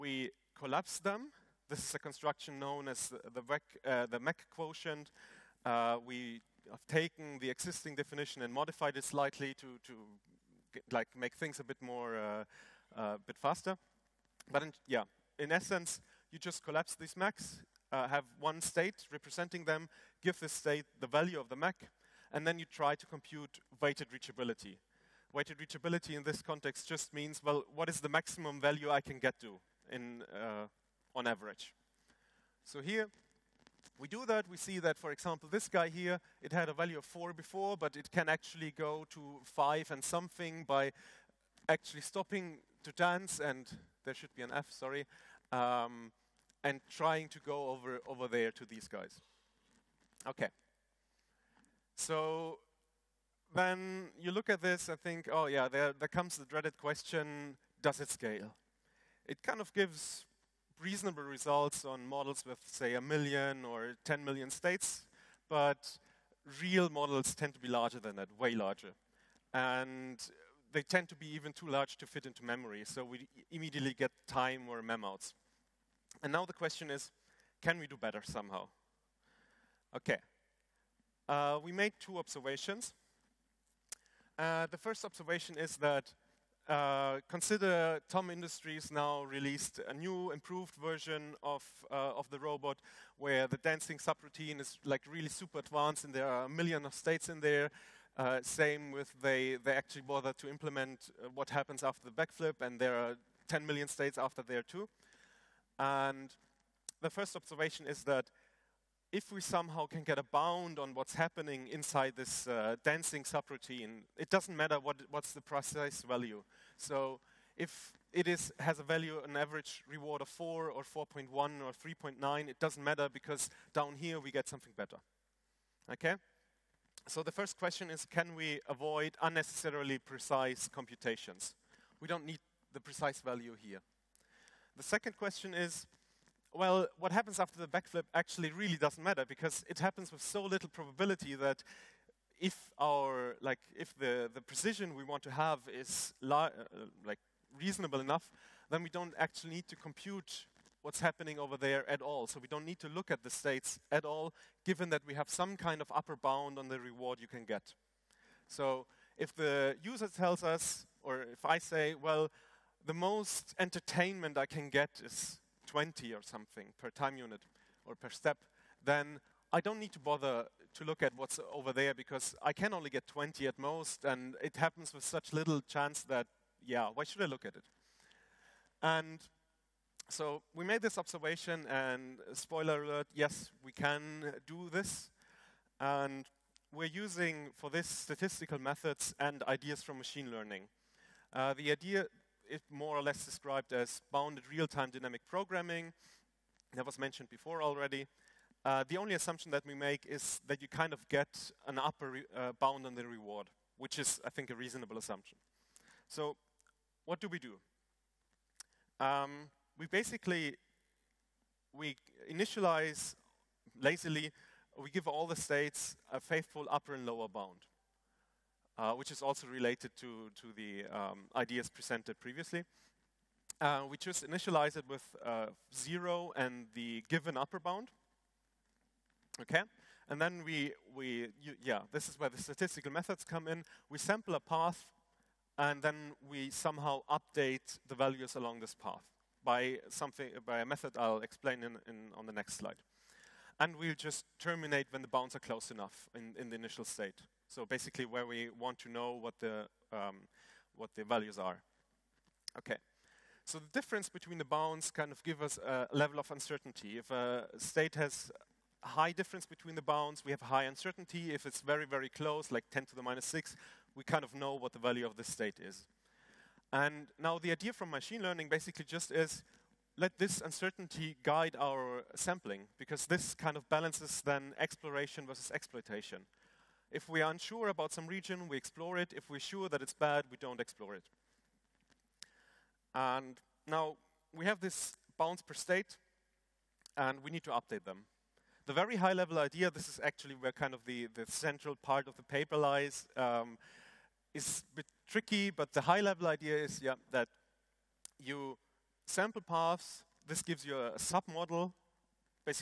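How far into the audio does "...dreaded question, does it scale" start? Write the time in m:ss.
0:56.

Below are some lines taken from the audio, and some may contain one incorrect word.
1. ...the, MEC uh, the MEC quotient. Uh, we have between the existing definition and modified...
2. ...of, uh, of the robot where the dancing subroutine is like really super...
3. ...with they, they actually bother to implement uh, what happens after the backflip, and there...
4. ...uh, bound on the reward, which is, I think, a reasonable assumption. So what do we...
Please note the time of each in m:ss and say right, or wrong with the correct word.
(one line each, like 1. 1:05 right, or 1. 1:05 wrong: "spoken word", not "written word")
1. 0:03 wrong: "taken", not "between"
2. 1:31 right
3. 1:38 right
4. 3:22 right.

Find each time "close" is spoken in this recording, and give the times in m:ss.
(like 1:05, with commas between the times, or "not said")
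4:05, 4:22.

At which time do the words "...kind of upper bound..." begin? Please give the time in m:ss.
2:35.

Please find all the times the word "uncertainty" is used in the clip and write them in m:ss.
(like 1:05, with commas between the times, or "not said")
4:16, 4:20, 4:30.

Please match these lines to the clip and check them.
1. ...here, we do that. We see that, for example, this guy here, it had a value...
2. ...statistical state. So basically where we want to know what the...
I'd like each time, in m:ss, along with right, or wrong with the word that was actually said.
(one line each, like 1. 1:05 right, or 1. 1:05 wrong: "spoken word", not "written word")
1. 0:32 right
2. 4:06 wrong: "initial", not "statistical".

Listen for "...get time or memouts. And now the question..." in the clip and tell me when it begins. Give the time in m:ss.
1:13.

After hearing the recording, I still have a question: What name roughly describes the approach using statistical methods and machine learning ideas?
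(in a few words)
bounded real-time dynamic programming.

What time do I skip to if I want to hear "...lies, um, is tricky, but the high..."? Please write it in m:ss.
4:52.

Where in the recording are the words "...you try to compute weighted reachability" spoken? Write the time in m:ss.
0:22.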